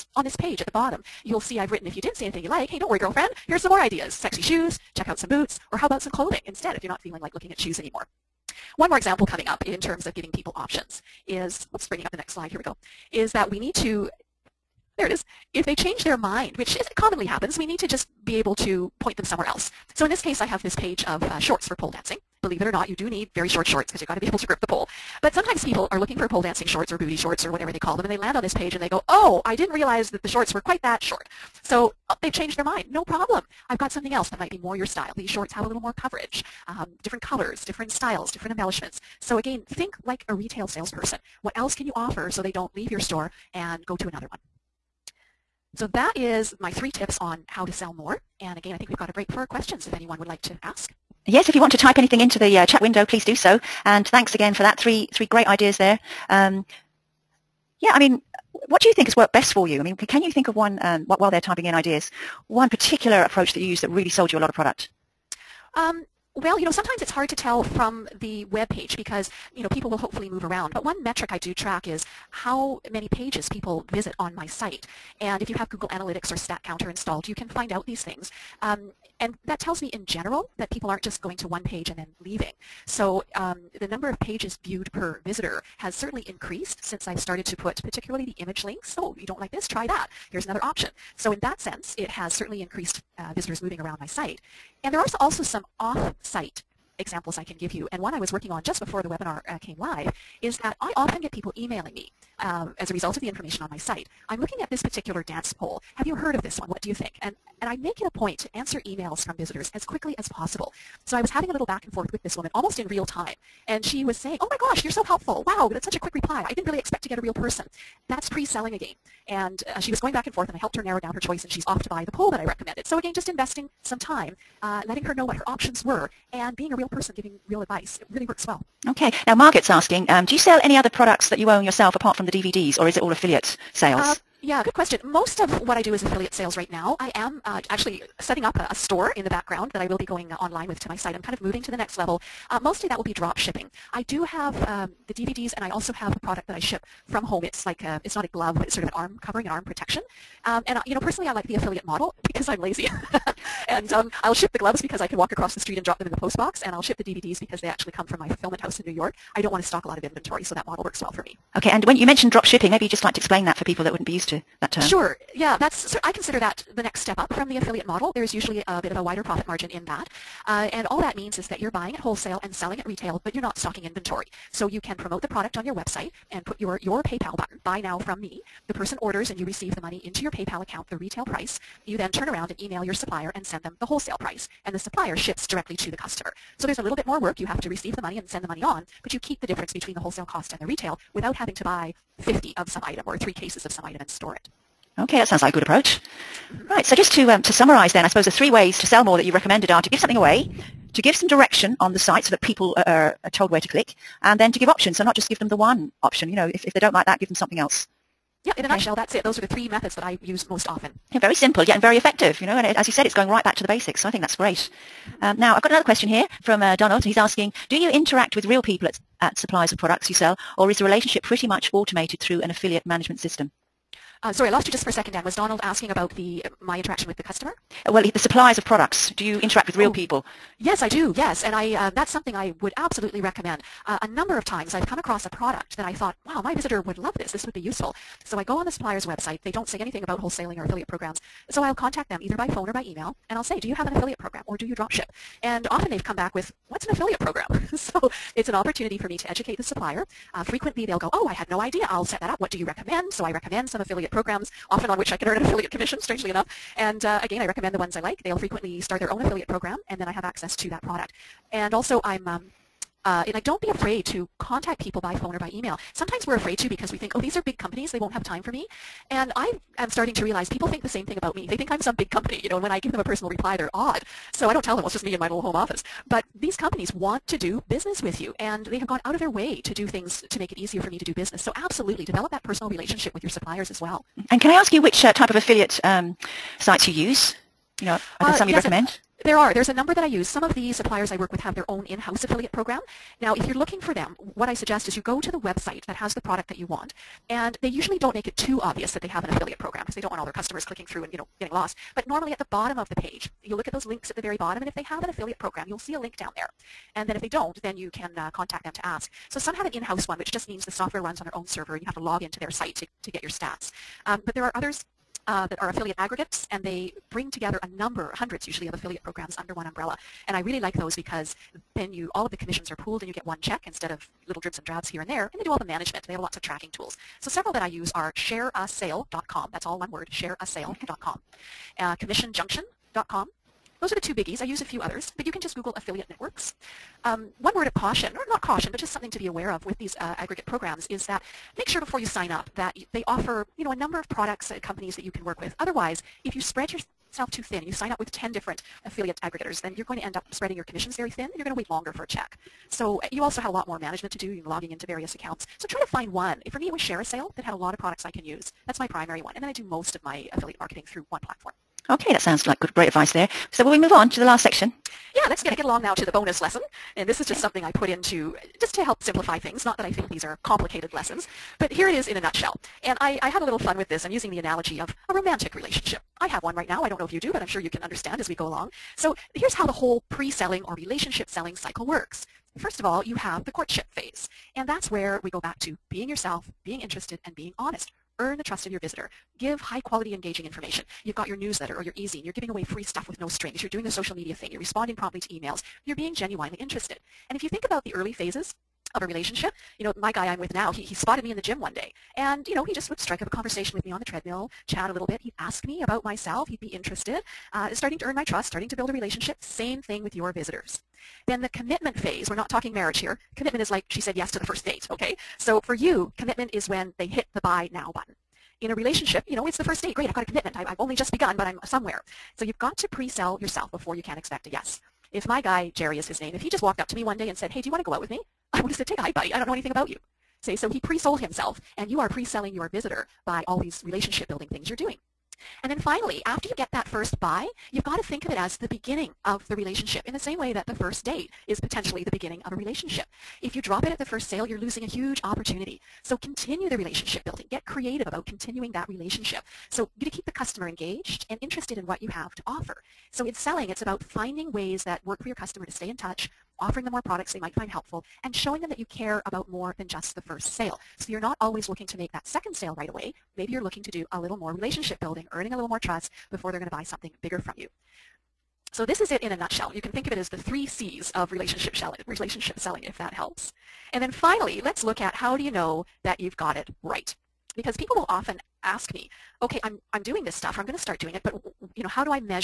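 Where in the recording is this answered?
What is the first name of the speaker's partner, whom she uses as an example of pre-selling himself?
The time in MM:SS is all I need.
07:05.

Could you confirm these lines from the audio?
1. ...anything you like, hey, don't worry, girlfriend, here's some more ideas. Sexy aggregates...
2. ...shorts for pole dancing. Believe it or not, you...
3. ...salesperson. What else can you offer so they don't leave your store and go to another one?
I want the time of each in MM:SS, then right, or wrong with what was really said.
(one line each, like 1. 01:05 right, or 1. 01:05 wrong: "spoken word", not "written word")
1. 00:02 wrong: "shoes", not "aggregates"
2. 00:21 right
3. 00:40 right.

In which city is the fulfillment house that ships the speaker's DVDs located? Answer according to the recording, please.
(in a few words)
New York.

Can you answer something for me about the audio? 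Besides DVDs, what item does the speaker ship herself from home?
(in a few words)
Arm covering.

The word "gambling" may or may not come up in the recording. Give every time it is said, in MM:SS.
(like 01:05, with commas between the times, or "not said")
not said.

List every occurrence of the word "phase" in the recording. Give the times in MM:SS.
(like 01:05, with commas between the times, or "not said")
06:23, 06:38, 06:51.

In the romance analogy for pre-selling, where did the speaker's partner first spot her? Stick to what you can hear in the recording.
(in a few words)
The gym.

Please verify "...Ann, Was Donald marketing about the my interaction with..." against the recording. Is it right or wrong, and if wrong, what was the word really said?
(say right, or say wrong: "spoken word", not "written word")
wrong: "asking", not "marketing".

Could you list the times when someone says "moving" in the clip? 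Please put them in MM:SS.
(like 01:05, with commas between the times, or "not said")
01:33, 02:21.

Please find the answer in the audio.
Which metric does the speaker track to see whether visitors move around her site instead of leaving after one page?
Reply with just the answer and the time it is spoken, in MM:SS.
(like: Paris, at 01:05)
Pages viewed per visitor, at 01:12.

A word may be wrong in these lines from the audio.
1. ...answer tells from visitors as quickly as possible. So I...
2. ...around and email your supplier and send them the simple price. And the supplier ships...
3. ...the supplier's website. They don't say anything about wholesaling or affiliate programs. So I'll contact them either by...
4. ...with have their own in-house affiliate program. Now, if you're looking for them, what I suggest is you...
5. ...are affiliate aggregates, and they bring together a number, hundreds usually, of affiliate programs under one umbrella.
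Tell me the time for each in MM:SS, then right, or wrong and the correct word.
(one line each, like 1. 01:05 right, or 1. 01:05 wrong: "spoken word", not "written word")
1. 01:48 wrong: "emails", not "tells"
2. 03:02 wrong: "wholesale", not "simple"
3. 03:58 right
4. 04:51 right
5. 05:15 right.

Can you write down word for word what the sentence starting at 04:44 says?
And can I ask you which uh, type of affiliate um, sites you use?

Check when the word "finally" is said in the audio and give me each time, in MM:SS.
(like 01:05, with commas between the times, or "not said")
07:15, 07:54.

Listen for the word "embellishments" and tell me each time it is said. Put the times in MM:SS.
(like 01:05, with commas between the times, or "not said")
00:38.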